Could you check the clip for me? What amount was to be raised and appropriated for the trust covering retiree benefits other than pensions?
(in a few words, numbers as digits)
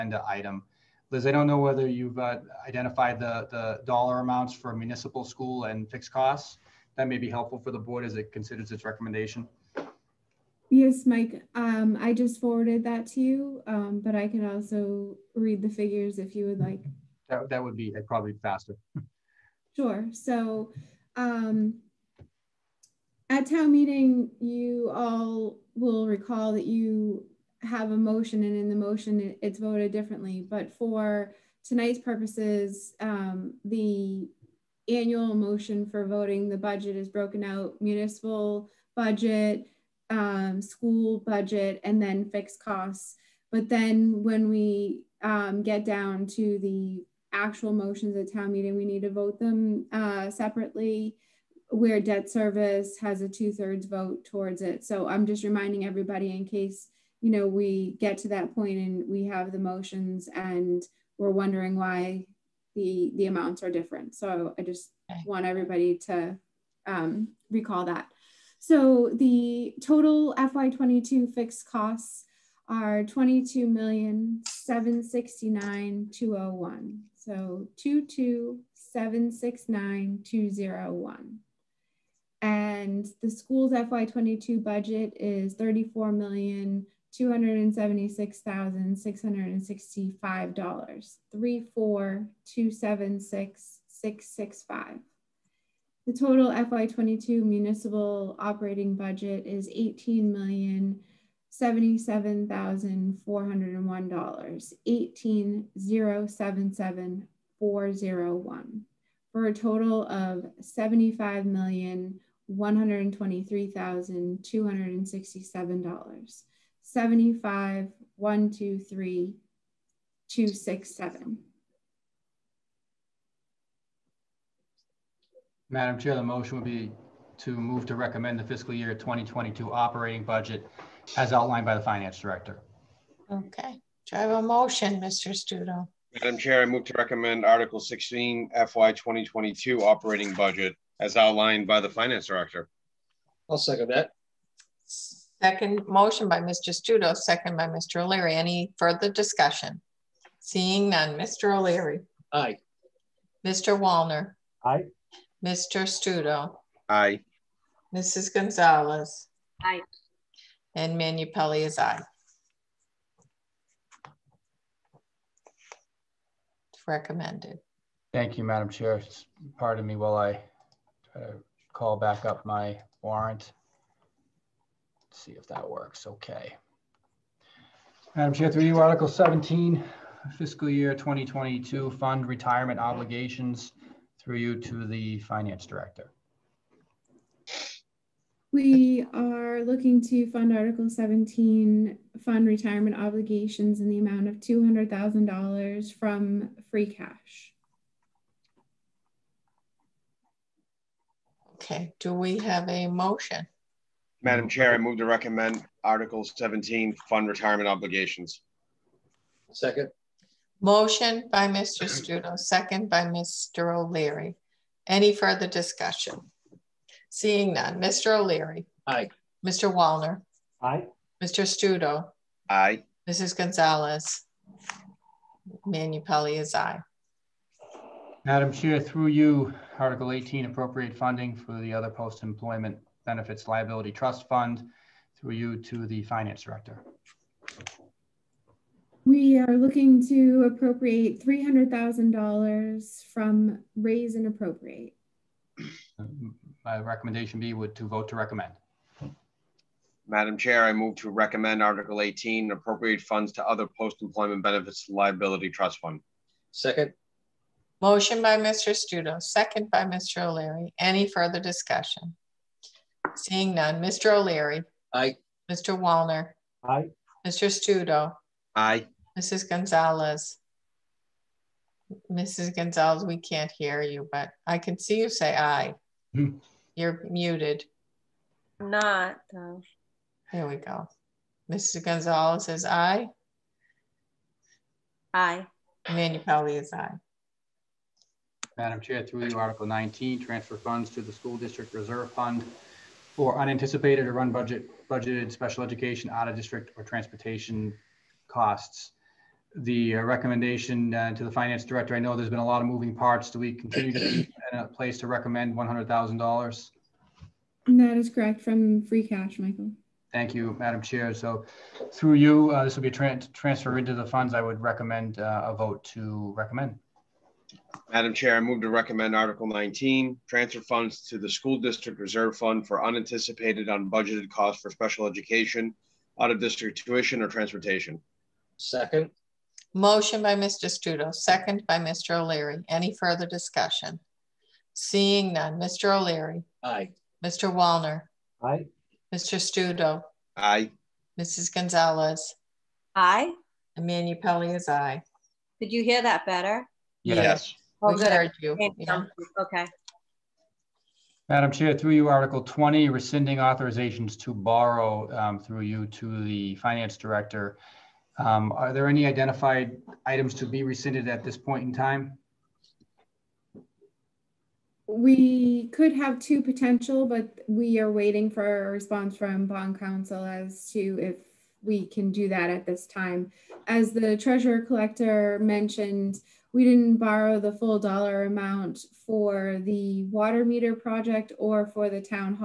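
$300,000.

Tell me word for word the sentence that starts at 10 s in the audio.
Yes, Mike, um, I just forwarded that to you, um, but I can also read the figures if you would like.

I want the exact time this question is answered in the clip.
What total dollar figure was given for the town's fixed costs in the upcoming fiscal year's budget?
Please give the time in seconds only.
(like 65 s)
73 s.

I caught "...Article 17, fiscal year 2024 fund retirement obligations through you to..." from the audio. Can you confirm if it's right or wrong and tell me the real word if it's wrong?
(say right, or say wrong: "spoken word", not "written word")
wrong: "2022", not "2024".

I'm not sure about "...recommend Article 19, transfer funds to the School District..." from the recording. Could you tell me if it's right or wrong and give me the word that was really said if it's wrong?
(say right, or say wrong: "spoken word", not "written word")
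right.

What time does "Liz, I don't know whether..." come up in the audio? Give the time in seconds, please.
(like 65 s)
1 s.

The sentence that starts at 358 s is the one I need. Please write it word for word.
Um, are there any identified items to be rescinded at this point in time?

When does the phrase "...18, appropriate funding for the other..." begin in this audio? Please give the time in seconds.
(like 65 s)
230 s.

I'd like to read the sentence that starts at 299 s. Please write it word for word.
The uh, recommendation uh, to the finance director, I know there's been a lot of moving parts.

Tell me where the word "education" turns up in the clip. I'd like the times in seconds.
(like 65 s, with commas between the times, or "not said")
295 s, 325 s.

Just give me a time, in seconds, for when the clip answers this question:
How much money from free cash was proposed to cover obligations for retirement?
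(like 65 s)
194 s.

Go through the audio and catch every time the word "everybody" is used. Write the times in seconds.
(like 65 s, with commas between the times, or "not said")
55 s, 65 s.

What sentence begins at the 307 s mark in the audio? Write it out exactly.
That is correct from free cash, Michael.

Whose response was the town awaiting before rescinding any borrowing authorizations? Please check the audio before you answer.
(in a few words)
Bond counsel.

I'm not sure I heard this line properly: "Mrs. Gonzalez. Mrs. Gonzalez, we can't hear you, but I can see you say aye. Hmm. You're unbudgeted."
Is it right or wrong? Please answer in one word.
wrong.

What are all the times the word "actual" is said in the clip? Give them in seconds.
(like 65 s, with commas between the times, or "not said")
47 s.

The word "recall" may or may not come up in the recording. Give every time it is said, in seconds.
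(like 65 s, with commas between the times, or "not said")
26 s, 67 s.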